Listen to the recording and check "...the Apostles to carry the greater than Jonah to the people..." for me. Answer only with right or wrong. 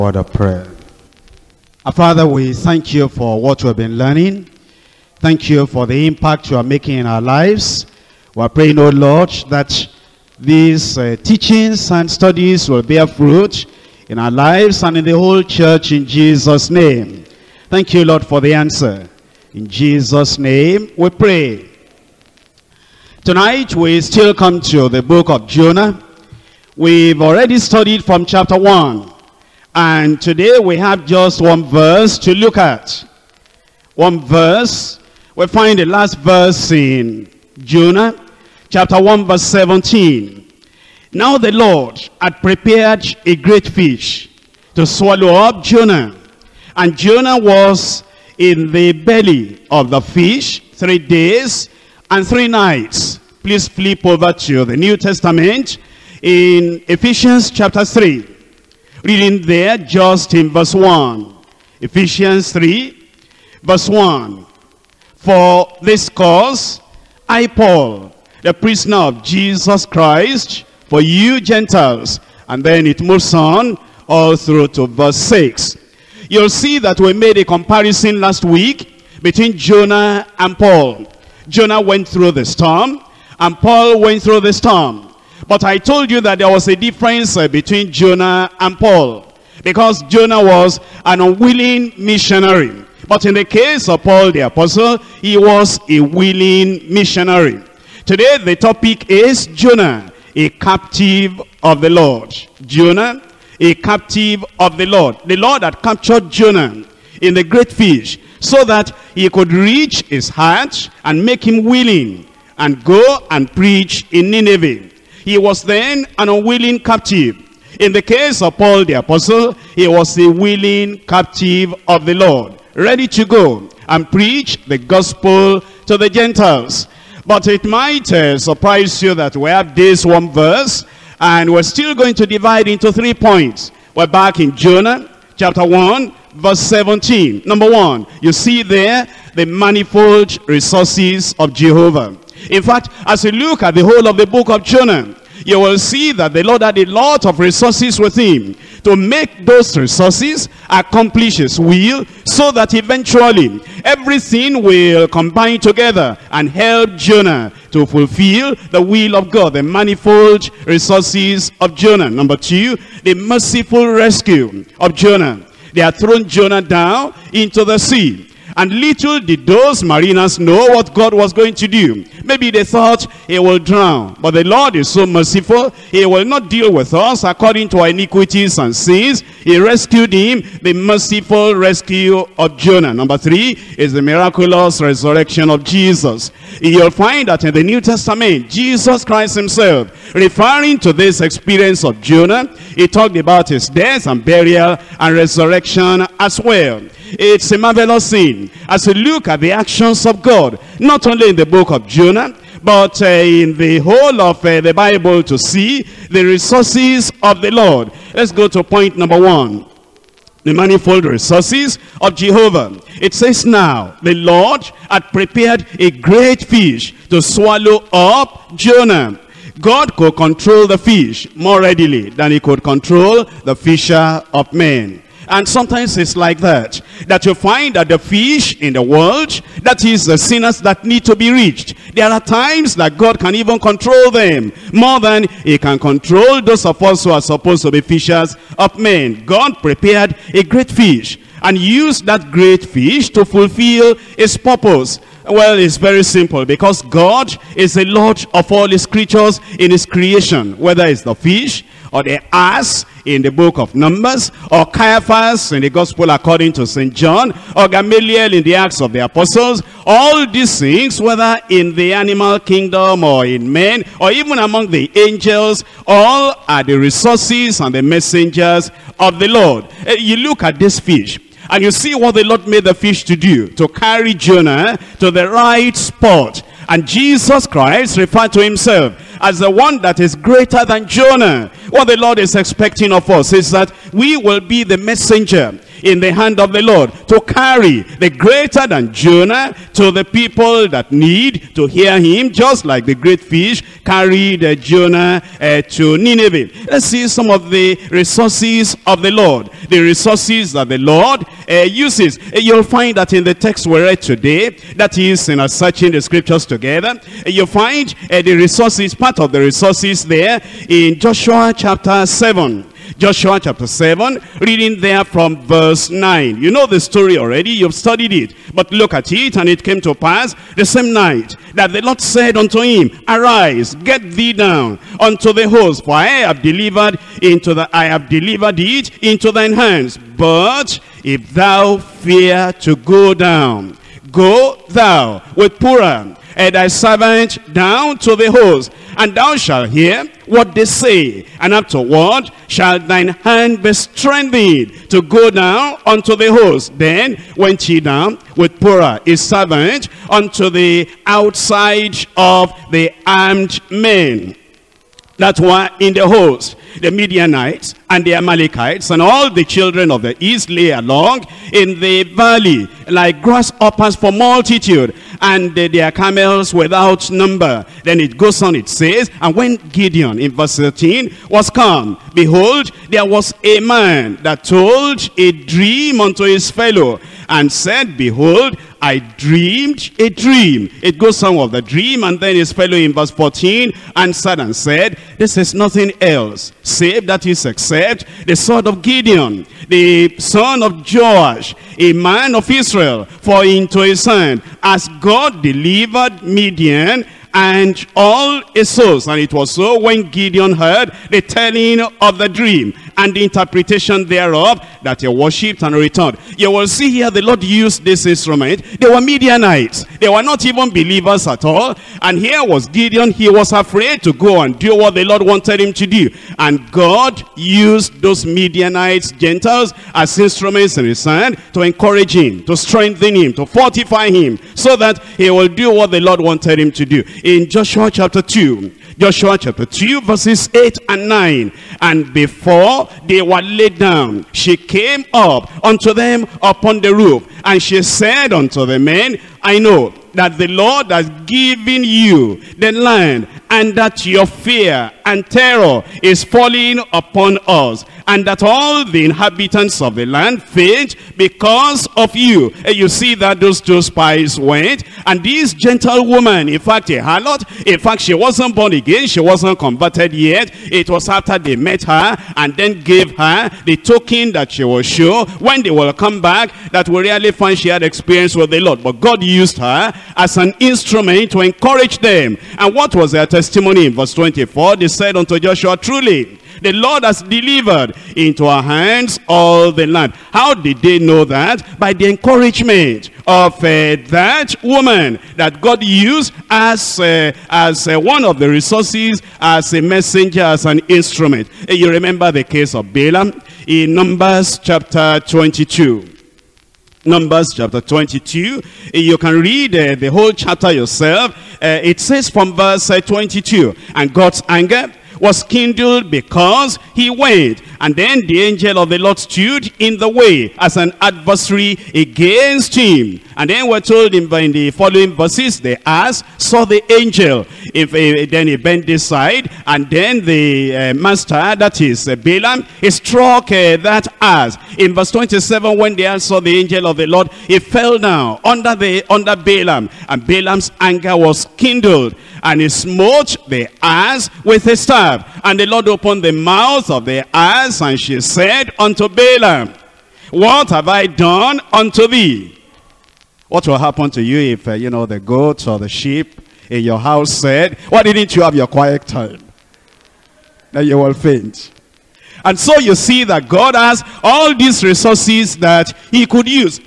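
wrong.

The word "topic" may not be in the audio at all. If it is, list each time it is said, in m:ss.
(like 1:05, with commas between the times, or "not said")
1:38.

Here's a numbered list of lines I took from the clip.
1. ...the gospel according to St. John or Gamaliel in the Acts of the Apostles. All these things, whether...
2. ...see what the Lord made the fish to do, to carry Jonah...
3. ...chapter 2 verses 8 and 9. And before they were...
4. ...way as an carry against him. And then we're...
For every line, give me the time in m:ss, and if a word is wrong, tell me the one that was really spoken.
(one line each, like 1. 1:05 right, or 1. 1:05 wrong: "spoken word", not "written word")
1. 4:15 right
2. 4:31 right
3. 7:09 right
4. 8:30 wrong: "adversary", not "carry".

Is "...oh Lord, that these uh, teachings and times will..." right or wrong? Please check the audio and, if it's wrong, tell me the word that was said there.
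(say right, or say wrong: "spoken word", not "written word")
wrong: "studies", not "times".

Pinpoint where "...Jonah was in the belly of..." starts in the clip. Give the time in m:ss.
0:46.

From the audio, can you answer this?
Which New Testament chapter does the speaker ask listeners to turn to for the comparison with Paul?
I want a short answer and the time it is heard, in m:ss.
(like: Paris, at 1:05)
Ephesians 3, at 0:56.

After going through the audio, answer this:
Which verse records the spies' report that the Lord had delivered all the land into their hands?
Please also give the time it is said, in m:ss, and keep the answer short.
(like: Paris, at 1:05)
Verse 24, at 7:53.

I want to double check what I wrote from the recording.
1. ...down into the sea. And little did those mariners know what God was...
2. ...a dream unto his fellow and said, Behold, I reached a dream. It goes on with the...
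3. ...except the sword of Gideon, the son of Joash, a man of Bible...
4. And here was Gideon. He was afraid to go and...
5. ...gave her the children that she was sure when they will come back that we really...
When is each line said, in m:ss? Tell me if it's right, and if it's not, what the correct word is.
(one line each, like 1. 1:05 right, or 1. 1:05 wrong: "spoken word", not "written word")
1. 2:46 right
2. 6:15 wrong: "dreamed", not "reached"
3. 6:27 wrong: "Israel", not "Bible"
4. 6:52 right
5. 7:42 wrong: "token", not "children".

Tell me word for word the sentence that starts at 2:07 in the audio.
But it might uh, surprise you that we have this one verse, and we're still going to divide into three points.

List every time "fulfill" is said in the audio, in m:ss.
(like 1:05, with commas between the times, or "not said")
2:37, 4:03.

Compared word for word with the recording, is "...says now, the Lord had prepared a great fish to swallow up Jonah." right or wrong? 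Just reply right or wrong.
right.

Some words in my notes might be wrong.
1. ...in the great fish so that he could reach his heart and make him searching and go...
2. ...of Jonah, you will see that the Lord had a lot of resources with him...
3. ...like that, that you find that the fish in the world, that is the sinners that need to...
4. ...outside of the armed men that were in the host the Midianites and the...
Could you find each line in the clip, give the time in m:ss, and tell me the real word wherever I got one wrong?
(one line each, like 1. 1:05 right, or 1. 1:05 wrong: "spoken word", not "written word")
1. 1:47 wrong: "willing", not "searching"
2. 2:24 right
3. 3:46 right
4. 5:51 right.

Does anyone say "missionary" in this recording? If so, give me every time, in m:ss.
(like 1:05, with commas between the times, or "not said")
1:31, 1:36.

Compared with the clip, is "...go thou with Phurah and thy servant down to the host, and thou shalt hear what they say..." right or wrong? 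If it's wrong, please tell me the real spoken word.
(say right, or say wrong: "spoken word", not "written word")
right.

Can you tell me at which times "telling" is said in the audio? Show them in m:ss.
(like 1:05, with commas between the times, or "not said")
6:41.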